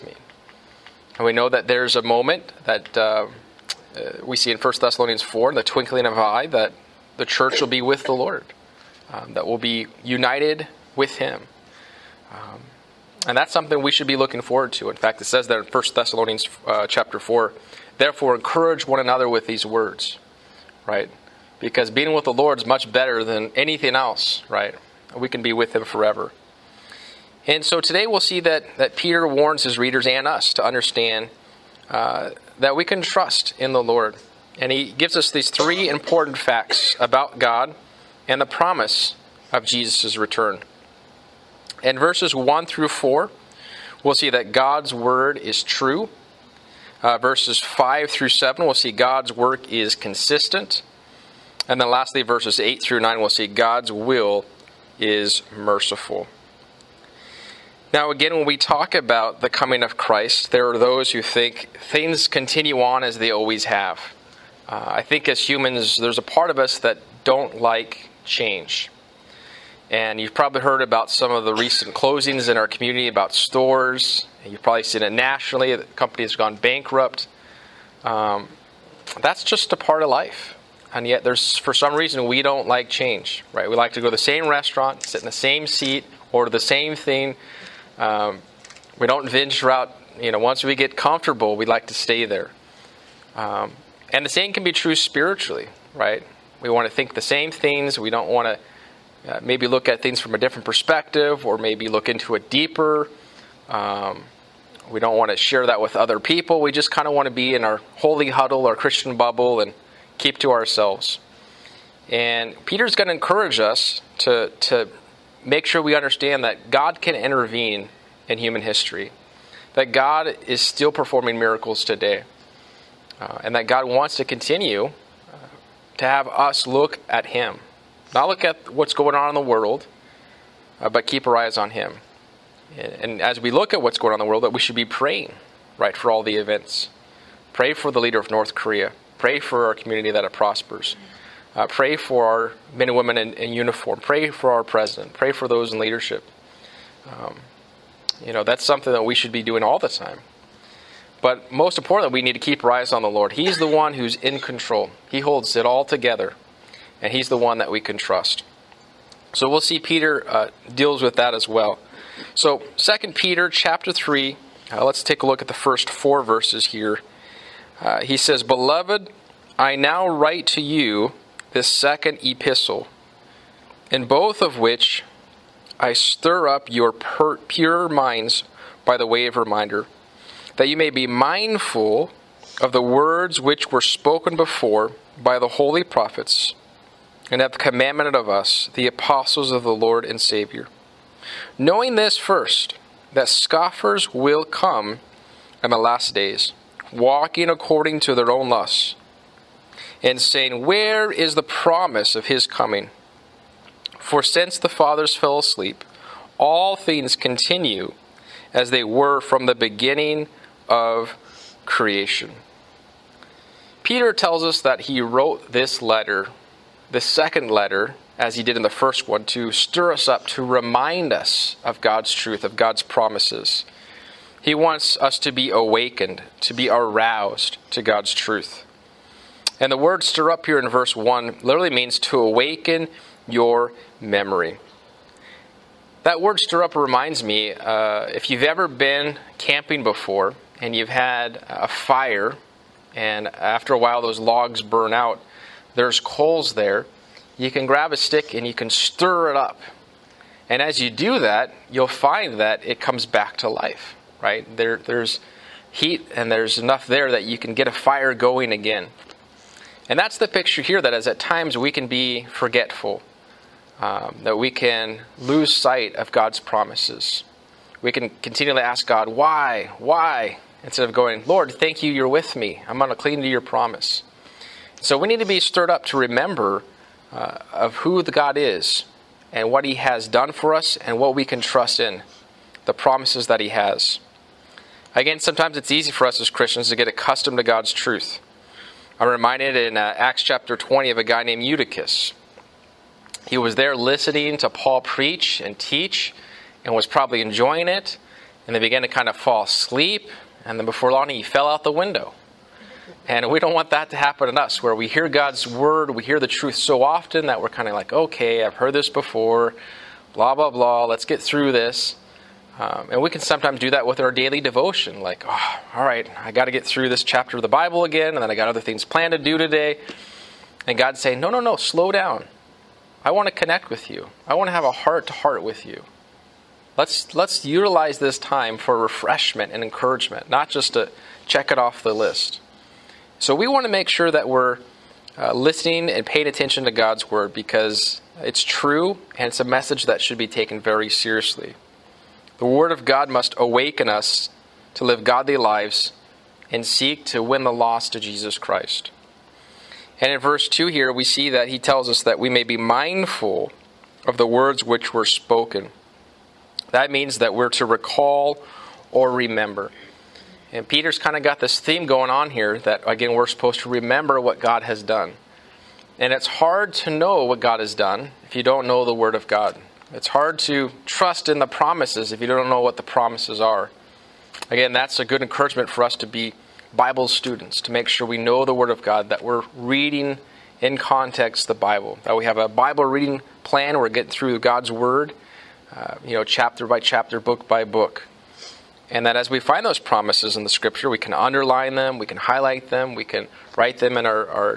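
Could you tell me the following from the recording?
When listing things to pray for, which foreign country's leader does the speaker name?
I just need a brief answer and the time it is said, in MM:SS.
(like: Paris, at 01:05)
North Korea, at 02:18.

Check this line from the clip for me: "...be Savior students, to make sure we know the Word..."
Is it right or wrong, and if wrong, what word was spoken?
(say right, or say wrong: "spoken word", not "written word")
wrong: "Bible", not "Savior".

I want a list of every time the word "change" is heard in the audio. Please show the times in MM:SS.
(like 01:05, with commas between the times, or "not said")
01:08, 01:22.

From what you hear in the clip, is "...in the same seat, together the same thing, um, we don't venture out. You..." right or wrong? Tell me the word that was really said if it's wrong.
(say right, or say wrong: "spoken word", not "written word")
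wrong: "order", not "together".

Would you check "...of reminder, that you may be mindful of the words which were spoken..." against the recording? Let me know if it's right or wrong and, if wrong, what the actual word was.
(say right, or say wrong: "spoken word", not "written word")
right.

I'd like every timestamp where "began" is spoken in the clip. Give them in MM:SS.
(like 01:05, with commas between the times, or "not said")
04:58.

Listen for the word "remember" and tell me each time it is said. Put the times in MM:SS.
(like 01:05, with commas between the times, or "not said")
04:35, 05:59, 06:03.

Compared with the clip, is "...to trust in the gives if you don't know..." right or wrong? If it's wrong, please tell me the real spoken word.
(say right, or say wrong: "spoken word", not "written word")
wrong: "promises", not "gives".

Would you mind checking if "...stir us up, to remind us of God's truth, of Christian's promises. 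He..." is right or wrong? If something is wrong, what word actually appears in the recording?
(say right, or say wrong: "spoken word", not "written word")
wrong: "God", not "Christian".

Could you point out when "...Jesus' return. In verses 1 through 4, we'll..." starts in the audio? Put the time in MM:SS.
00:39.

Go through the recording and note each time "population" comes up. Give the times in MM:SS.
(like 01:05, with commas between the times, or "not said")
not said.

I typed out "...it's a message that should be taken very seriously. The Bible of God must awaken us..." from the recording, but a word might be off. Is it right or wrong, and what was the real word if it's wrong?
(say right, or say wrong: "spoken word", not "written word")
wrong: "Word", not "Bible".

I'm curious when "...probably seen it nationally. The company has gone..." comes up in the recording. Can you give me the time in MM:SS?
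01:14.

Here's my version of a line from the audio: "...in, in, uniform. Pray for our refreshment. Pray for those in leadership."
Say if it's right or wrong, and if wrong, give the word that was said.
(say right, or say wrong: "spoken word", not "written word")
wrong: "president", not "refreshment".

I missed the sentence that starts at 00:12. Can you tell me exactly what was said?
Um, and that's something we should be looking forward to.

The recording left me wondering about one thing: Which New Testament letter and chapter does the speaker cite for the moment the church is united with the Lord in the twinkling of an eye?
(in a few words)
1 Thessalonians 4.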